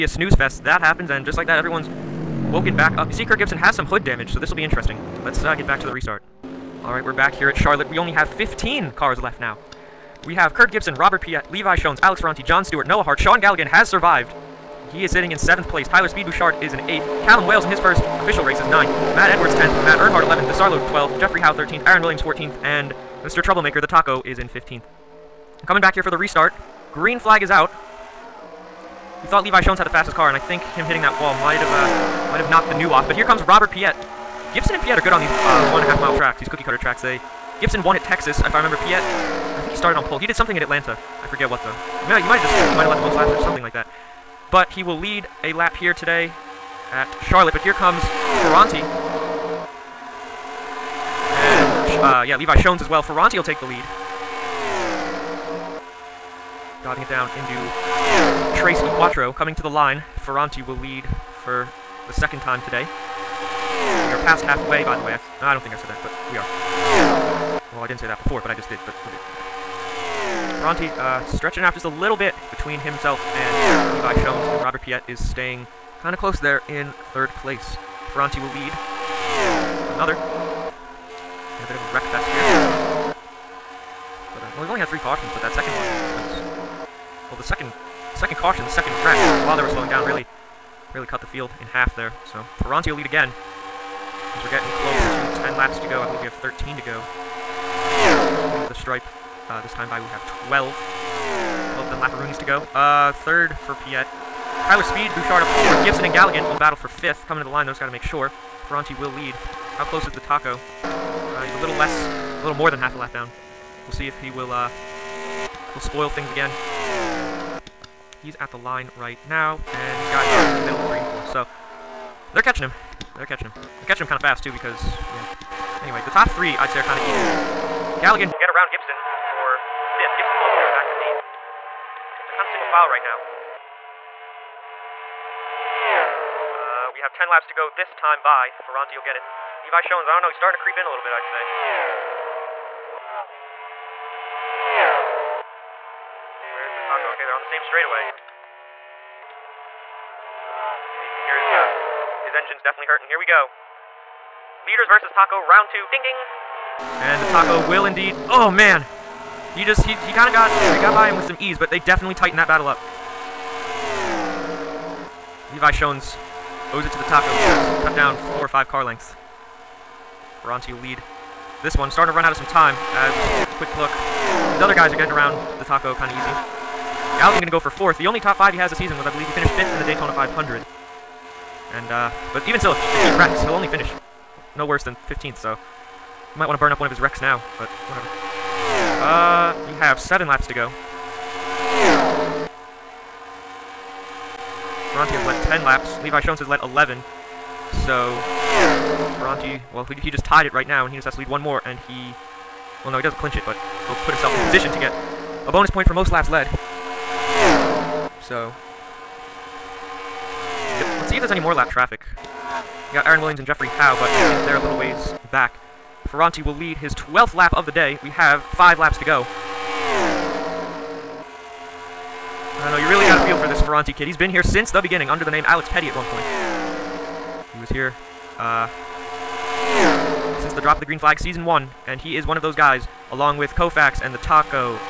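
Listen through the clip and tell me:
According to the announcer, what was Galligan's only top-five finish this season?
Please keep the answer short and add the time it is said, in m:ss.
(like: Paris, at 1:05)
fifth in the Daytona 500, at 2:59.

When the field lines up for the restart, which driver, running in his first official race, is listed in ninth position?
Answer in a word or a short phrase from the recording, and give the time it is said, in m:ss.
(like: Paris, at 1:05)
Callum Wales, at 0:17.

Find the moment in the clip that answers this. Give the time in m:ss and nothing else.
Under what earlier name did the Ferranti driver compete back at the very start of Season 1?
3:45.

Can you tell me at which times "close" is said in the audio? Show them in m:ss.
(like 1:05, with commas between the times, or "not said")
1:16, 1:34, 1:49.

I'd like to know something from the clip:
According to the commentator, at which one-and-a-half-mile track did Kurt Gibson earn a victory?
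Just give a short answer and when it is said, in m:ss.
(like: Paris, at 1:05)
Texas, at 0:38.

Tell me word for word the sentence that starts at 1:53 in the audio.
We'll see if he will, uh, will spoil things again.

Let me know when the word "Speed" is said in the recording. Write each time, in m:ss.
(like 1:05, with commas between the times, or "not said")
0:16, 1:44.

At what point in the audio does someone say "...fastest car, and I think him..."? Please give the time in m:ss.
0:29.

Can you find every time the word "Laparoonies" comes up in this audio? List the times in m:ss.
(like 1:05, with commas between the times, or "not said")
1:42.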